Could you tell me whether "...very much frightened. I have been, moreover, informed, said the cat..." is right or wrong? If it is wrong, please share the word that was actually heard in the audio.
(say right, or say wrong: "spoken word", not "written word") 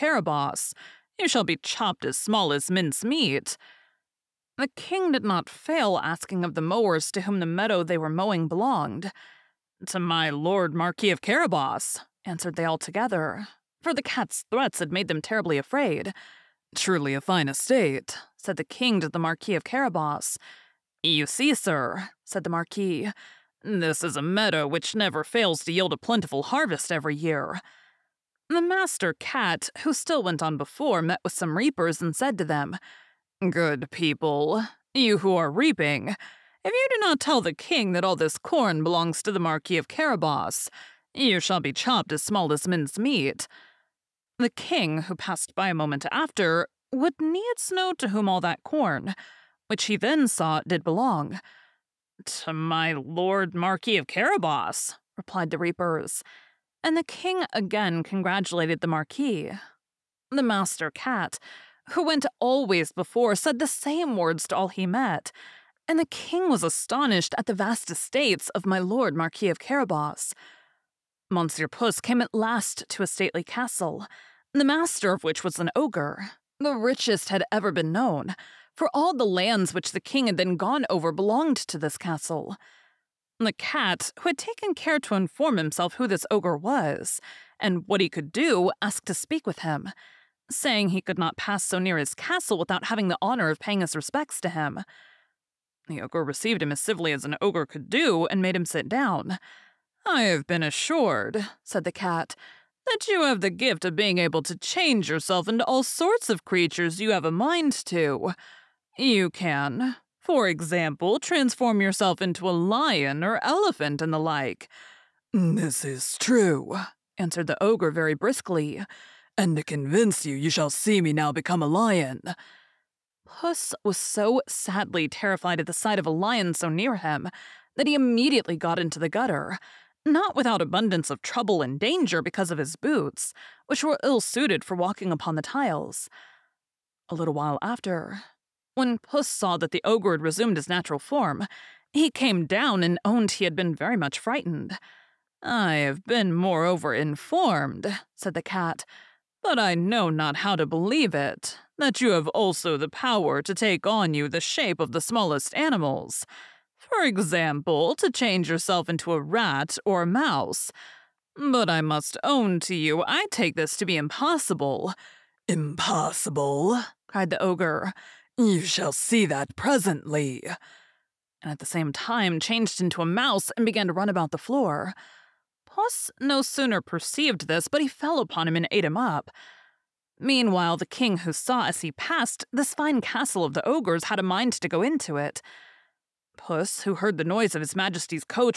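right.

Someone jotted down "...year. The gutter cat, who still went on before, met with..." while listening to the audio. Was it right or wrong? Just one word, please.
wrong.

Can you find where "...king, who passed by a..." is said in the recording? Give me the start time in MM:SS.
00:44.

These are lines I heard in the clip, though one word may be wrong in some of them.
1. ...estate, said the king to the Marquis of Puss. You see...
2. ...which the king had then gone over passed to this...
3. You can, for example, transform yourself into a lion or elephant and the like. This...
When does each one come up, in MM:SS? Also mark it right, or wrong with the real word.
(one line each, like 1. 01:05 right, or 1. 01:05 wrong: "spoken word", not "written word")
1. 00:17 wrong: "Carabas", not "Puss"
2. 01:19 wrong: "belonged", not "passed"
3. 01:48 right.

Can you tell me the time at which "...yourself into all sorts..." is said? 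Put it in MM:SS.
01:45.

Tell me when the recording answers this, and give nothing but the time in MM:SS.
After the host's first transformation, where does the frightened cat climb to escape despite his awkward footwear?
02:08.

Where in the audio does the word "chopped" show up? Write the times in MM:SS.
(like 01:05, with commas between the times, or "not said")
00:01, 00:41.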